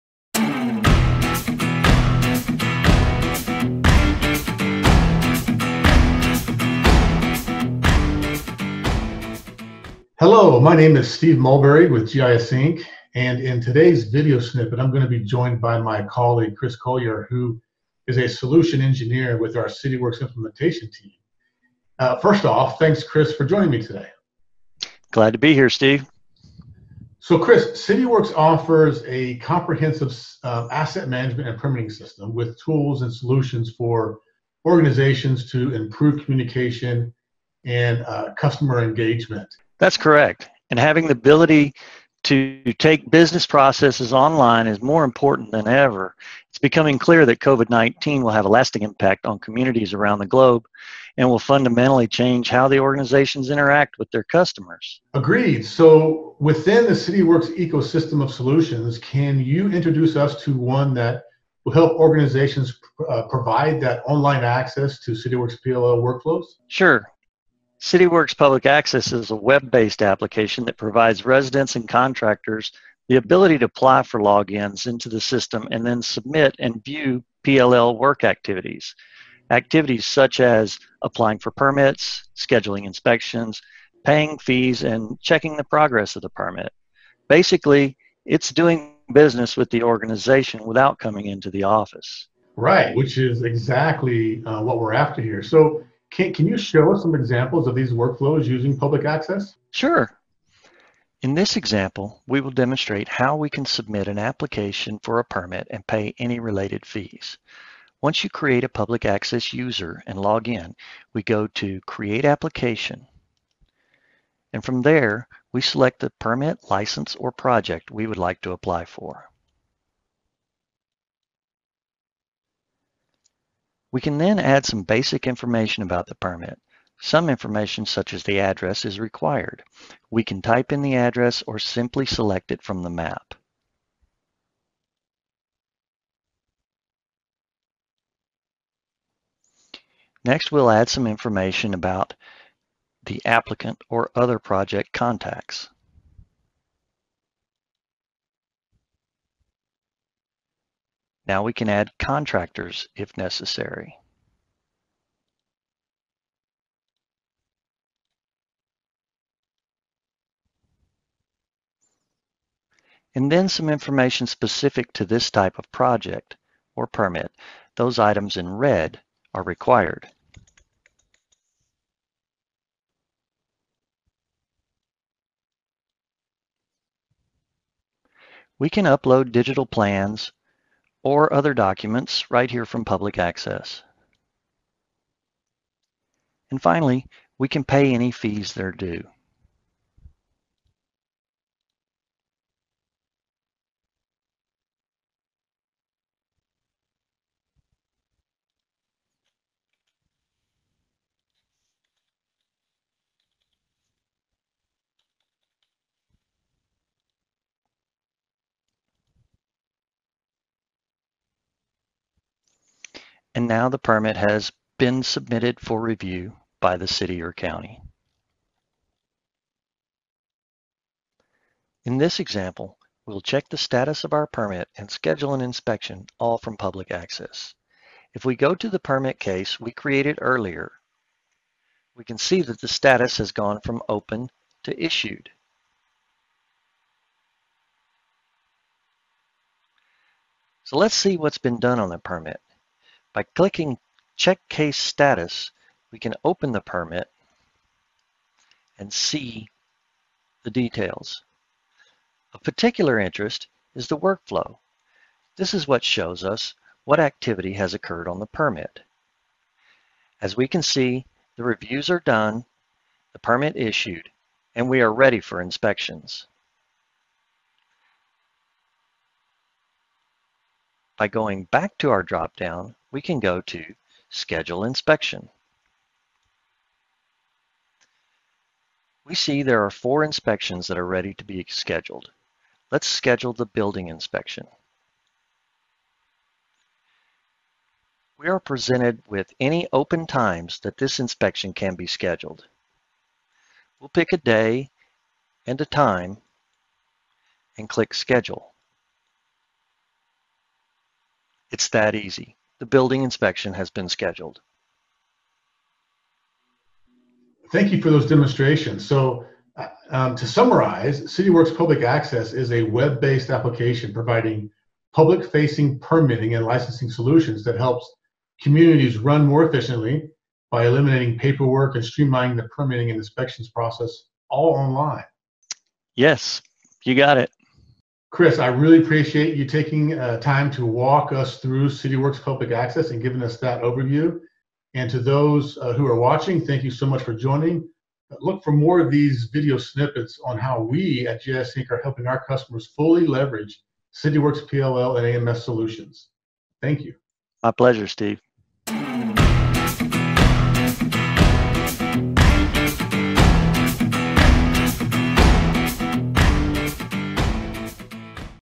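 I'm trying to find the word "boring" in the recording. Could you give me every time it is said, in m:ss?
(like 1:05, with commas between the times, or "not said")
not said.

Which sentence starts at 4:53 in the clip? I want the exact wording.
We'll pick a day and a time and click schedule.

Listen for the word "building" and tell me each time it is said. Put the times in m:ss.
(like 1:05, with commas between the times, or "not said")
4:43, 5:02.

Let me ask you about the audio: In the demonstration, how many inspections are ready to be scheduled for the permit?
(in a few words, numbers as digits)
4.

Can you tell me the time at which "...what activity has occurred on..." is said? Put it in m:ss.
4:16.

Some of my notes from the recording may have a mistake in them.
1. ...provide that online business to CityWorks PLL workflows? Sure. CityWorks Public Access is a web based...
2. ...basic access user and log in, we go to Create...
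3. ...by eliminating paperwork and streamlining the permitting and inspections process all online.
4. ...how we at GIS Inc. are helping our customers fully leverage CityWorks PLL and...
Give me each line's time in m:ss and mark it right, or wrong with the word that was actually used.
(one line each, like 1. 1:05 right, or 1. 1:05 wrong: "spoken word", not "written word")
1. 1:03 wrong: "access", not "business"
2. 1:48 wrong: "public", not "basic"
3. 5:20 right
4. 5:40 right.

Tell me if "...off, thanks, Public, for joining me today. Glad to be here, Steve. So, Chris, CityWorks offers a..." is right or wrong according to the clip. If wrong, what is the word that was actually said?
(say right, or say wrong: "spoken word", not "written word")
wrong: "Chris", not "Public".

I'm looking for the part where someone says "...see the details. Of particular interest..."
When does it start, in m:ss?
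4:08.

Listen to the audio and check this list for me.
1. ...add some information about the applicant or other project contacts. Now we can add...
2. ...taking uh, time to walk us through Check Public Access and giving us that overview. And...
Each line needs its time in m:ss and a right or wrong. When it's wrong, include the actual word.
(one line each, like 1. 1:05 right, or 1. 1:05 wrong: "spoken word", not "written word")
1. 2:20 right
2. 5:29 wrong: "CityWorks", not "Check".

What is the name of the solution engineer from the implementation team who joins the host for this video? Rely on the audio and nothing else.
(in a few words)
Chris Collier.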